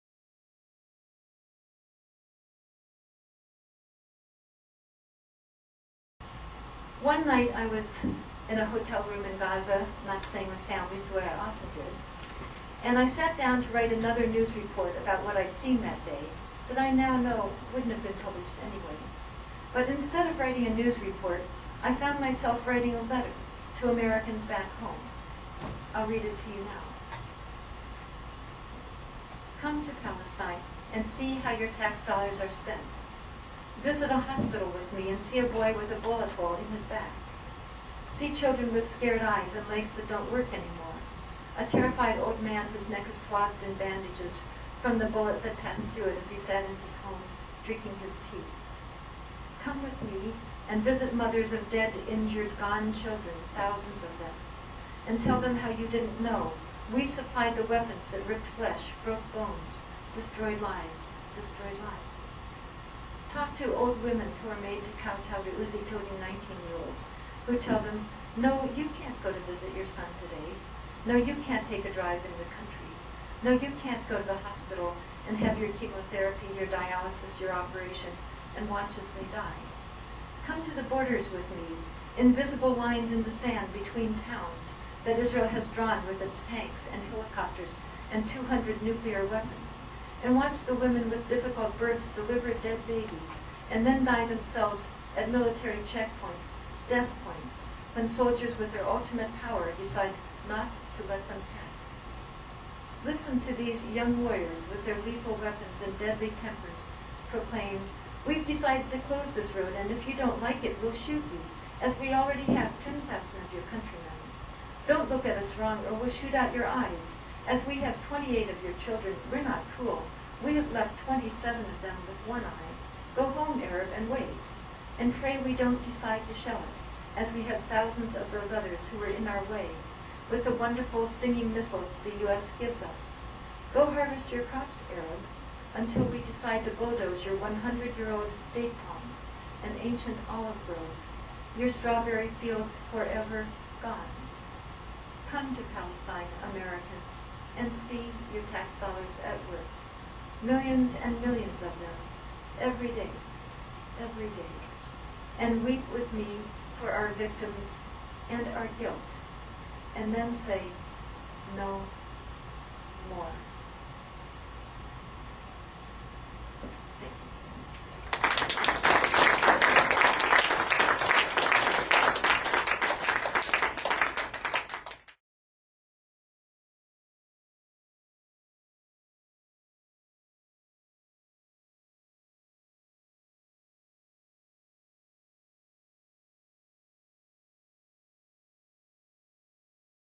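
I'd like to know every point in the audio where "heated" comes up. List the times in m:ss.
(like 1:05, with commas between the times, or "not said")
not said.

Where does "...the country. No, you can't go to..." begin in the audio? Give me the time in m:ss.
1:12.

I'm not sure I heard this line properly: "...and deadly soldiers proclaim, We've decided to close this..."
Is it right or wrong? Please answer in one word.
wrong.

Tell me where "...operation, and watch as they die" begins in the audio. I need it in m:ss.
1:17.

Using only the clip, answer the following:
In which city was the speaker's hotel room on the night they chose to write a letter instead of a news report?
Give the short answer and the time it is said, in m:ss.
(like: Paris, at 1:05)
Gaza, at 0:09.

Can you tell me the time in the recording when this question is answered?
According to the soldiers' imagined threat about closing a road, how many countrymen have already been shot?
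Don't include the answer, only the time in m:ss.
1:52.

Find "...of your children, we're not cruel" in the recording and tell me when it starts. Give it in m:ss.
1:58.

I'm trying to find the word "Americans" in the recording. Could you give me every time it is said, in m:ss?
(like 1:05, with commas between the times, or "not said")
0:23, 2:26.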